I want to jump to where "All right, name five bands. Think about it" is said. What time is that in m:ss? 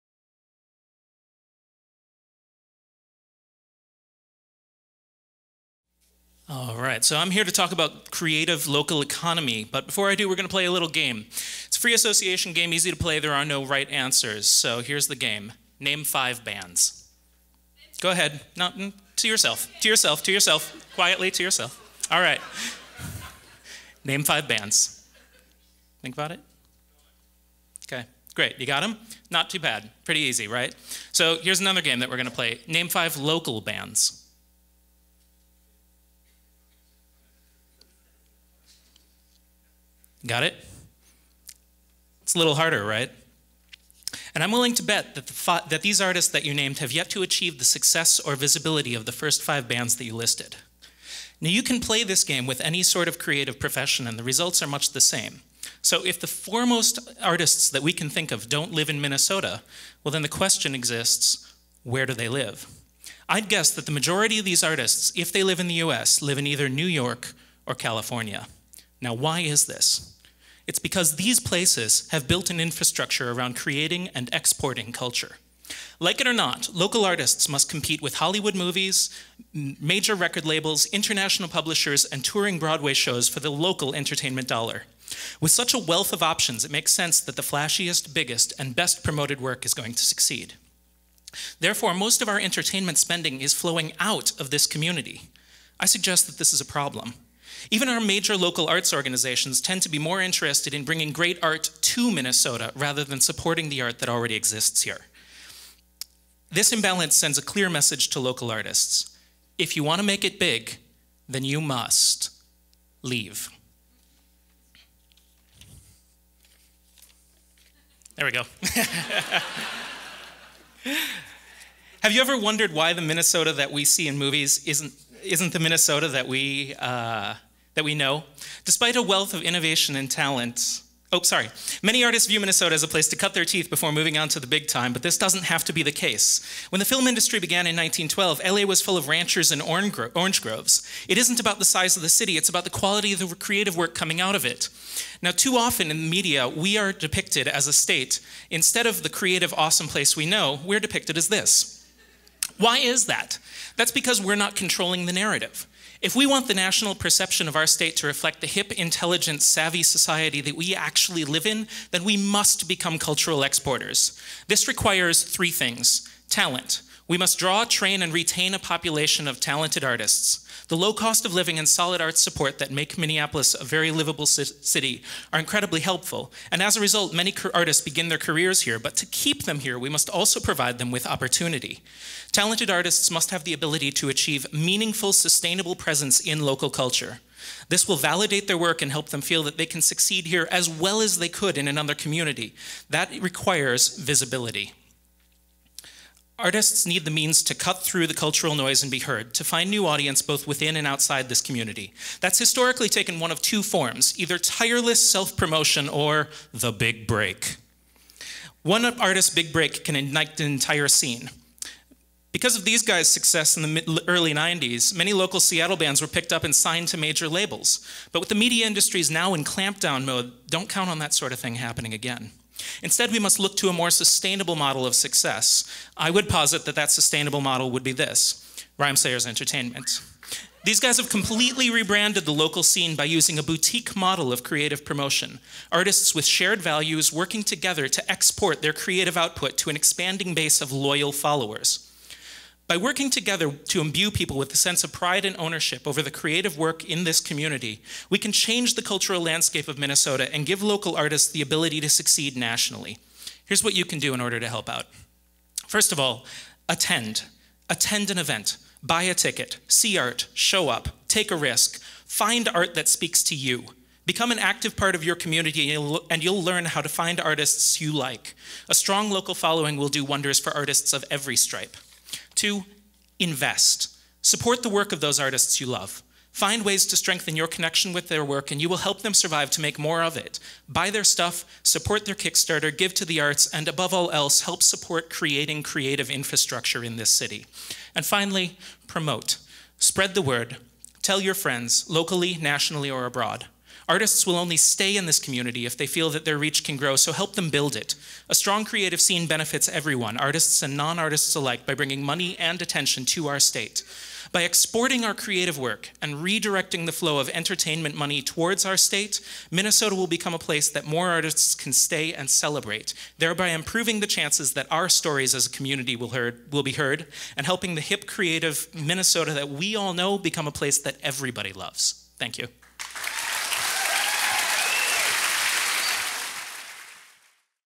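0:22.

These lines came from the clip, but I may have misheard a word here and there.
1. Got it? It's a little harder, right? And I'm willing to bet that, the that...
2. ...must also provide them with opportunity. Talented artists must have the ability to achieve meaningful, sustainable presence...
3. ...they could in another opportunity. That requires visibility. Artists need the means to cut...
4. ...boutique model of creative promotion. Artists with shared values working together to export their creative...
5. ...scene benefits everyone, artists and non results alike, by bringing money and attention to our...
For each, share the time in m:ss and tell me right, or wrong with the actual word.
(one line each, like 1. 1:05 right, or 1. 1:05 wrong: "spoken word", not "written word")
1. 0:40 right
2. 2:59 right
3. 3:11 wrong: "community", not "opportunity"
4. 3:53 right
5. 4:59 wrong: "artists", not "results".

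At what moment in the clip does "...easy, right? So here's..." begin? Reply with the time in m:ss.
0:30.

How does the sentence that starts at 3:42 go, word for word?
Instead, we must look to a more sustainable model of success.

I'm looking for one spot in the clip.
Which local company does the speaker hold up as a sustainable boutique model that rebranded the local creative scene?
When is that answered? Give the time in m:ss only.
3:48.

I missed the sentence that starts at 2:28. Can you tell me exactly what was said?
Instead of the creative, awesome place we know, we're depicted as this why is that?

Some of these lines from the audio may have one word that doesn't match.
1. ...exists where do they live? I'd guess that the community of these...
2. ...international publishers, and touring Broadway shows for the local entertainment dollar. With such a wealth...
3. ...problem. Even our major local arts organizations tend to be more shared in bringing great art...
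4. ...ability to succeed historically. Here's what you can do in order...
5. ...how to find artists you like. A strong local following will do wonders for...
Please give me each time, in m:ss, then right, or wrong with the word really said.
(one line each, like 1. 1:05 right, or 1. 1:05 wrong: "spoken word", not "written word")
1. 1:00 wrong: "majority", not "community"
2. 1:20 right
3. 1:36 wrong: "interested", not "shared"
4. 4:11 wrong: "nationally", not "historically"
5. 4:26 right.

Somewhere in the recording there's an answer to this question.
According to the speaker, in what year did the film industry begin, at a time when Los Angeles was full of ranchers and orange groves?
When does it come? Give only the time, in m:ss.
2:17.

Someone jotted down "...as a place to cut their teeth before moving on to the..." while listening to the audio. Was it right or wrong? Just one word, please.
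right.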